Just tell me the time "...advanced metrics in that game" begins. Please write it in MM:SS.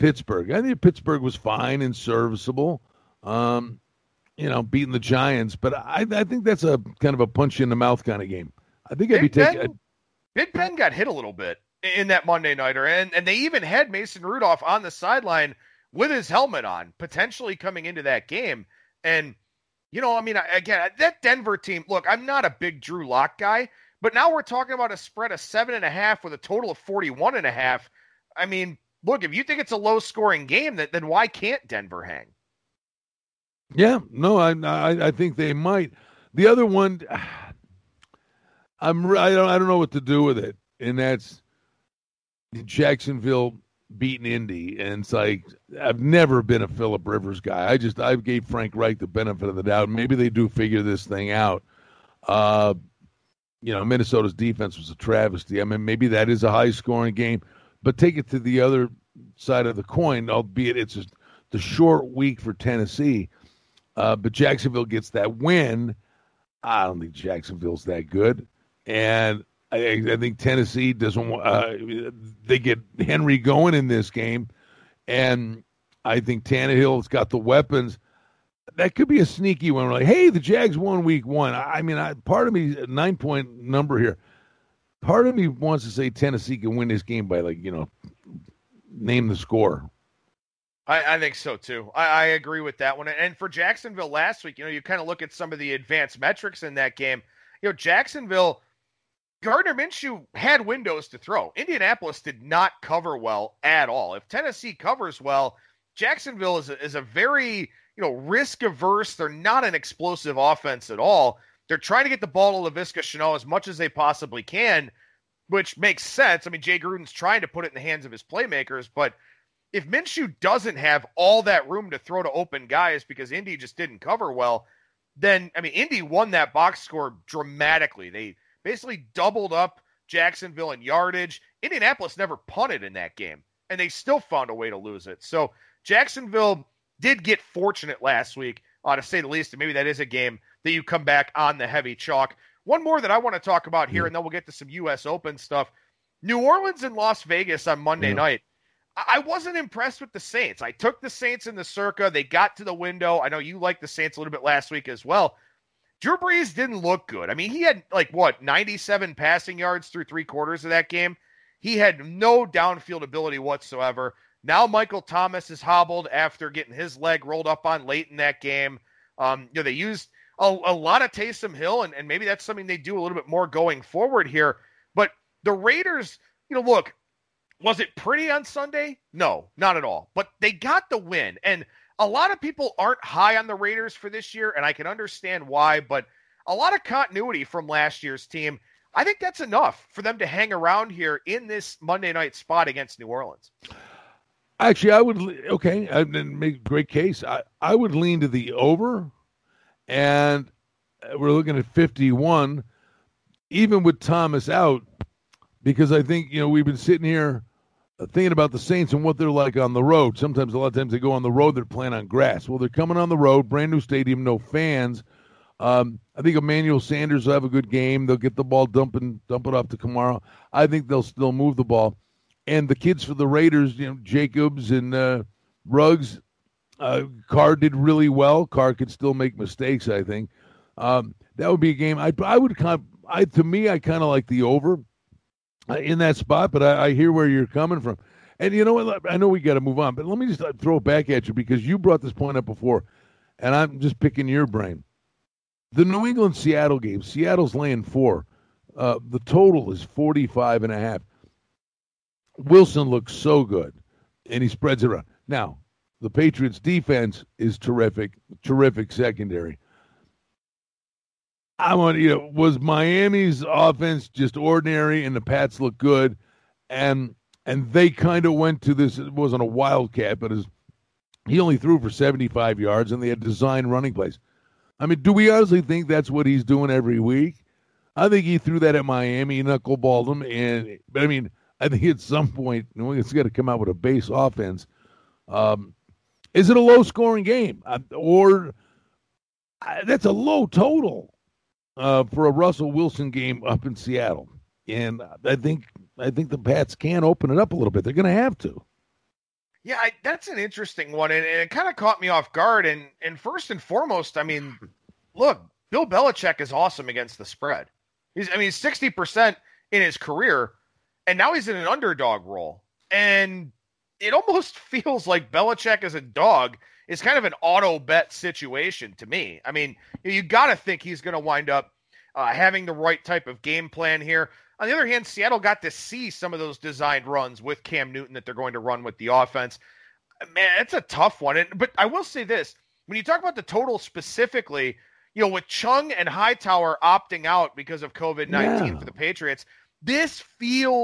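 01:35.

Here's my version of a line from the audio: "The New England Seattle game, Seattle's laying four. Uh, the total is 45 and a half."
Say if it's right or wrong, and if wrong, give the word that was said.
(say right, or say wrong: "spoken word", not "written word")
right.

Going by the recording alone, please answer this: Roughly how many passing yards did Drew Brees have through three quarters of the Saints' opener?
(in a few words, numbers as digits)
97.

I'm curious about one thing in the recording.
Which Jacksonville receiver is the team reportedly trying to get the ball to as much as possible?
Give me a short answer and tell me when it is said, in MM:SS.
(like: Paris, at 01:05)
Laviska Shenault, at 01:52.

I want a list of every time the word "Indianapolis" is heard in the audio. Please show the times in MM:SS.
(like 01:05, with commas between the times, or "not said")
01:41, 02:11.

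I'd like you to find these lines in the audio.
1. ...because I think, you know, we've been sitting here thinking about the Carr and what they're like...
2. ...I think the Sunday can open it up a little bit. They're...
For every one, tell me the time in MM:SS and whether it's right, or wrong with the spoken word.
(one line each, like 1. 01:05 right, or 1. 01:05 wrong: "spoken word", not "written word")
1. 03:25 wrong: "Saints", not "Carr"
2. 04:55 wrong: "Pats", not "Sunday".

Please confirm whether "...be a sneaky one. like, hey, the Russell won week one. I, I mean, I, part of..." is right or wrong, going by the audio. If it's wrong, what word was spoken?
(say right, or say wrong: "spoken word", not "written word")
wrong: "Jags", not "Russell".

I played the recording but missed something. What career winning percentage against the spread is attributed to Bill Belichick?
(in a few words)
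60 percent.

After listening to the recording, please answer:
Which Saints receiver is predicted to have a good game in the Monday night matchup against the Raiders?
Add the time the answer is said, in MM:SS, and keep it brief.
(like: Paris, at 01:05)
Emmanuel Sanders, at 03:36.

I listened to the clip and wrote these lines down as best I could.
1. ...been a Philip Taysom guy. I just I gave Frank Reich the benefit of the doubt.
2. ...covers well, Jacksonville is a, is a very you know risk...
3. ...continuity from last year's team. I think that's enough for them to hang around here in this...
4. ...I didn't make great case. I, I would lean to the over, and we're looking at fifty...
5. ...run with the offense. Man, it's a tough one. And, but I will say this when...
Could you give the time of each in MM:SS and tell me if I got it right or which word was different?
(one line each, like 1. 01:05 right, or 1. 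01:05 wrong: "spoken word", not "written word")
1. 00:46 wrong: "Rivers", not "Taysom"
2. 01:44 right
3. 03:06 right
4. 03:15 right
5. 05:28 right.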